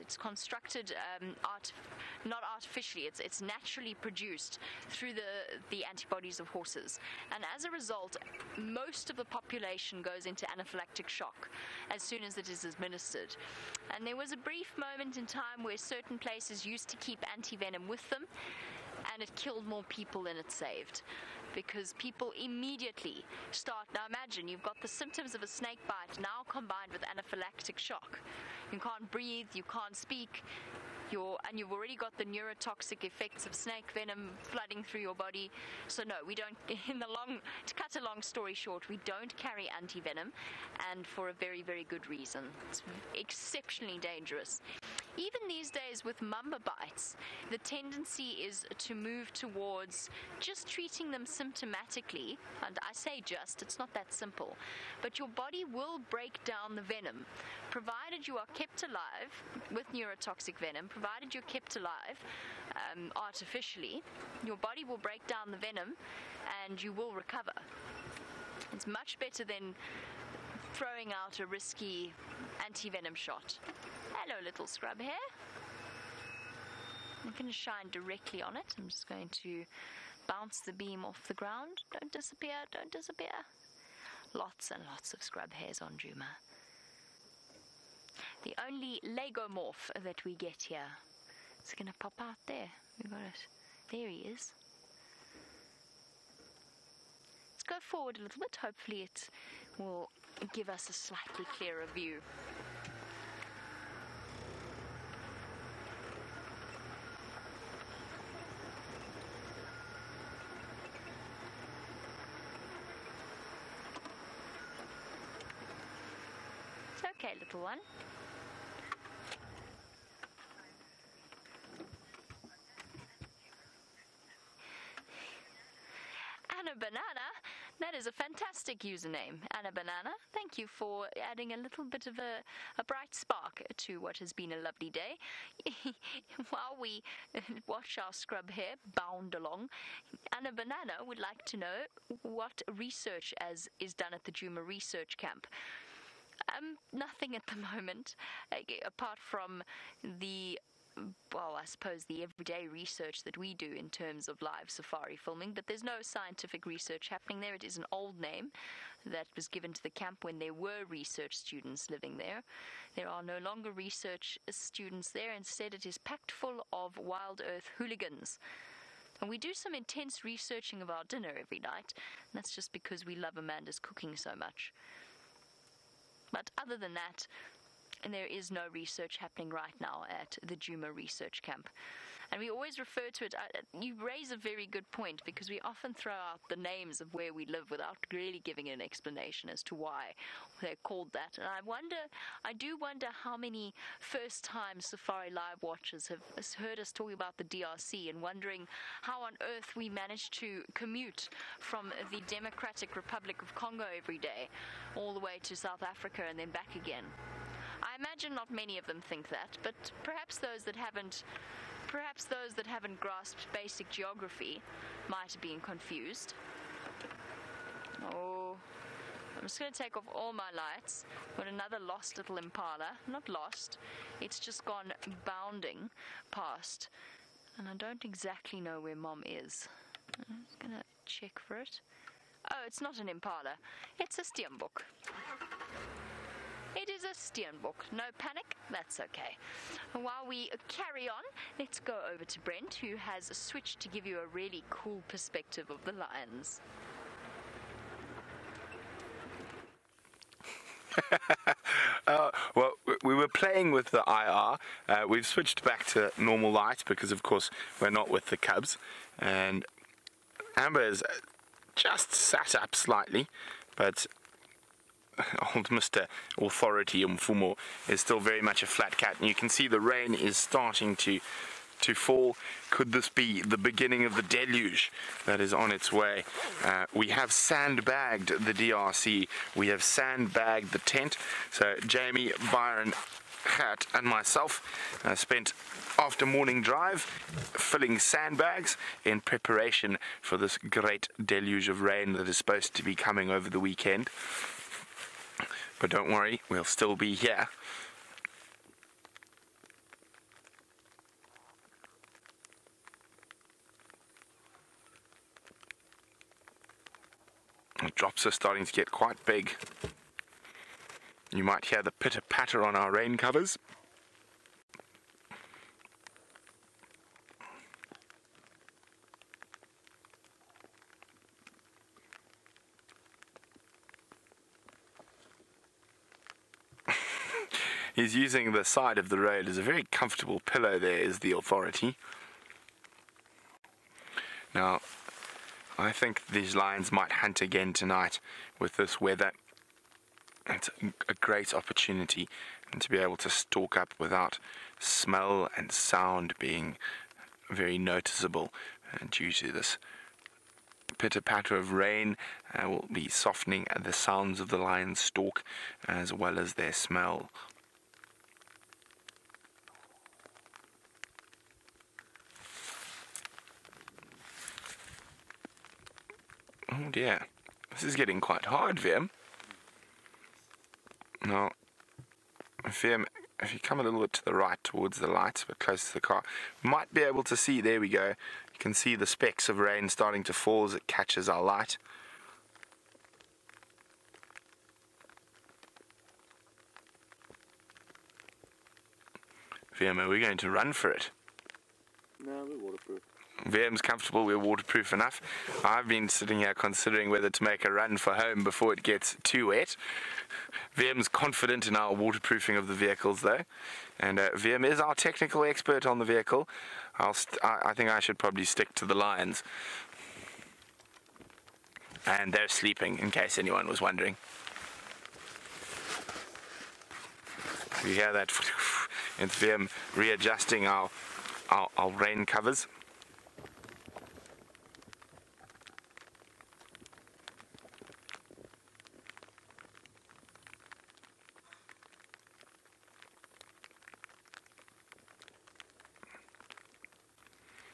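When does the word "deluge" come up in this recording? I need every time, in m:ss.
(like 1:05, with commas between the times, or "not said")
4:34, 4:51.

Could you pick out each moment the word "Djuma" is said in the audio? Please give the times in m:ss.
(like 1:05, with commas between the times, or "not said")
1:25, 2:24, 3:00.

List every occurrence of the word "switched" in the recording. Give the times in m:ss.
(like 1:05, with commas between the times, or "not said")
4:03, 4:15.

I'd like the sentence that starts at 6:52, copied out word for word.
And they're sleeping, in case anyone was wondering.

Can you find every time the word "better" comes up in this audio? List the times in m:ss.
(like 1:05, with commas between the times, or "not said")
1:09.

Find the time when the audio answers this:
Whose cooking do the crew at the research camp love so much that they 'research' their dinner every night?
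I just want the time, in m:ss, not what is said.
2:53.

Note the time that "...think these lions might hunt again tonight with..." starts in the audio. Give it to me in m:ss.
5:35.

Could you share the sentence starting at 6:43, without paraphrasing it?
And uh, VM is our technical expert on the vehicle.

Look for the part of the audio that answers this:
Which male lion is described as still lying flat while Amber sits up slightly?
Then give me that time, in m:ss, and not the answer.
4:27.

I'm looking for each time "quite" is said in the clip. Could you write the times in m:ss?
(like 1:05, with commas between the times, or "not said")
5:08, 6:08.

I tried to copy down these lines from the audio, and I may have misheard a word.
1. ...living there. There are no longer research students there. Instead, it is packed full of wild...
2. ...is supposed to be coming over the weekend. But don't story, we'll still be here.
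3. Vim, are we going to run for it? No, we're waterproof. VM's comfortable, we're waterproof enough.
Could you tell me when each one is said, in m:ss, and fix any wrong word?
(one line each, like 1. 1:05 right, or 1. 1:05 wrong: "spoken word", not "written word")
1. 2:41 right
2. 4:52 wrong: "worry", not "story"
3. 6:29 right.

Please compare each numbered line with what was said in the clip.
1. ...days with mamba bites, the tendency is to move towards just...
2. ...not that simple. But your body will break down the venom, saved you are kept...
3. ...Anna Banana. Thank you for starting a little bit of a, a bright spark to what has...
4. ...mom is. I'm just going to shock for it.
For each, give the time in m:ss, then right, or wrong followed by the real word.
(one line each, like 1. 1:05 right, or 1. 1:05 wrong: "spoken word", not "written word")
1. 0:45 right
2. 0:53 wrong: "provided", not "saved"
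3. 2:09 wrong: "adding", not "starting"
4. 3:48 wrong: "check", not "shock".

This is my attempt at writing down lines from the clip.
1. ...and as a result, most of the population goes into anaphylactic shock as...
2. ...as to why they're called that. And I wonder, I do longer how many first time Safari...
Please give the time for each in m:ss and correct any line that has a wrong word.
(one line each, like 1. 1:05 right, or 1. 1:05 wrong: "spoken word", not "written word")
1. 0:07 right
2. 3:09 wrong: "wonder", not "longer".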